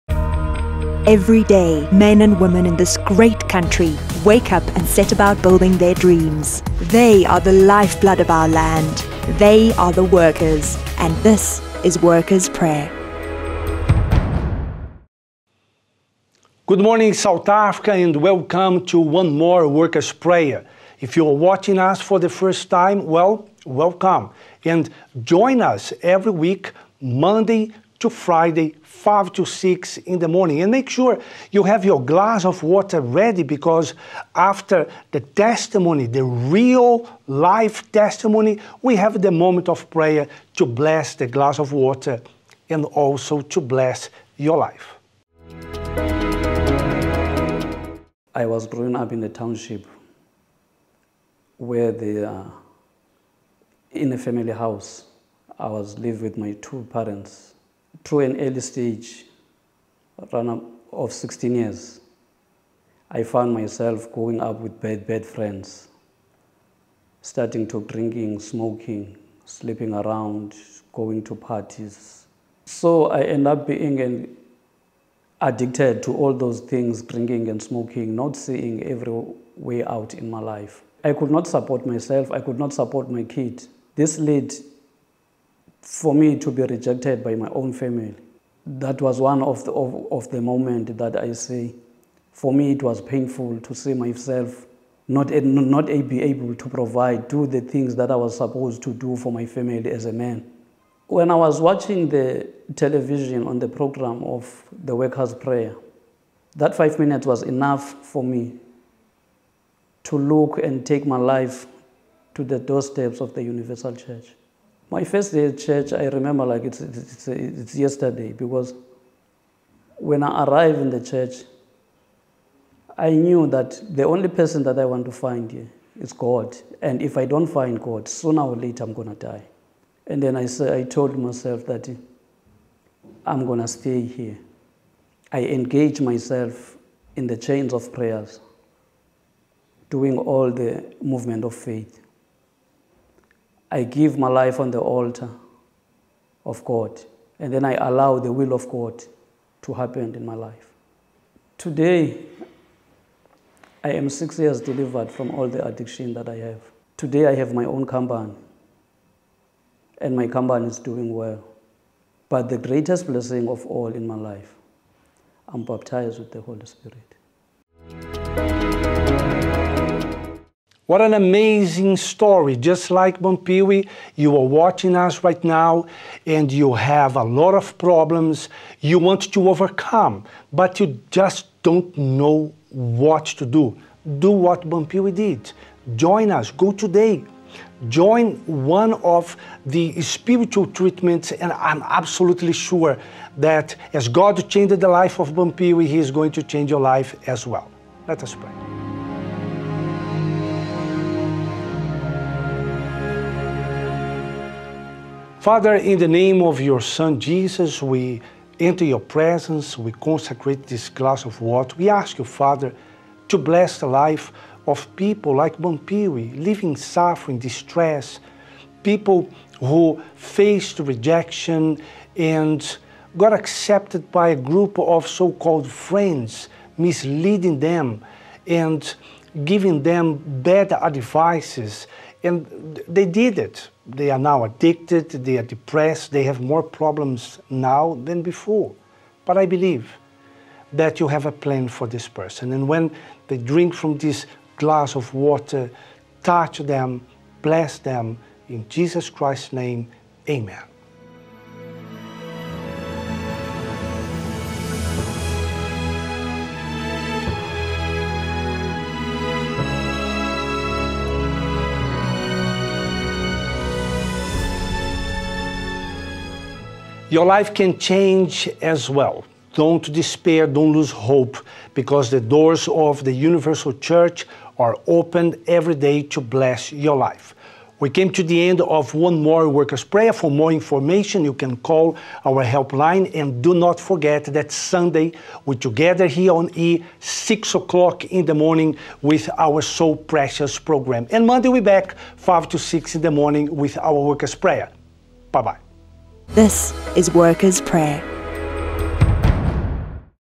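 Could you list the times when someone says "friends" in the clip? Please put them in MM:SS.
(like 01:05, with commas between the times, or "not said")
01:05, 03:45.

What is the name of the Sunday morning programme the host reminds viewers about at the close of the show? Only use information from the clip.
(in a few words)
So Precious.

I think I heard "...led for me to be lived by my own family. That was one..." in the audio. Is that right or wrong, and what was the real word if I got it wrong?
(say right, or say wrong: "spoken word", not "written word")
wrong: "rejected", not "lived".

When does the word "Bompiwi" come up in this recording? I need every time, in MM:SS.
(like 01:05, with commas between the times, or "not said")
02:53, 03:04.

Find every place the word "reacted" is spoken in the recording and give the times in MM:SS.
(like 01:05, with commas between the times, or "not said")
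not said.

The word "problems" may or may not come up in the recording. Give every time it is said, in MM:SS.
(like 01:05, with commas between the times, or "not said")
02:57, 03:56.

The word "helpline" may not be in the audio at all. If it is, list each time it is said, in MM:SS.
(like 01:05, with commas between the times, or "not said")
04:42.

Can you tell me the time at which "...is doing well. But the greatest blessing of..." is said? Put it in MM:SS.
02:40.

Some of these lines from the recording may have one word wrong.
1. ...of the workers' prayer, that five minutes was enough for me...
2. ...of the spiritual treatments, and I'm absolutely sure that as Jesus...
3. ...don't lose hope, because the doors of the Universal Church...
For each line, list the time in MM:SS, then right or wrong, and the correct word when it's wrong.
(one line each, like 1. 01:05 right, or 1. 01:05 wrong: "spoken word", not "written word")
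1. 01:44 right
2. 03:08 wrong: "God", not "Jesus"
3. 04:30 right.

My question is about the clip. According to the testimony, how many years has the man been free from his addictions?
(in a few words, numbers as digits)
6.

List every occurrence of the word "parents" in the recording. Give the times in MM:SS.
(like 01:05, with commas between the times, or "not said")
00:56.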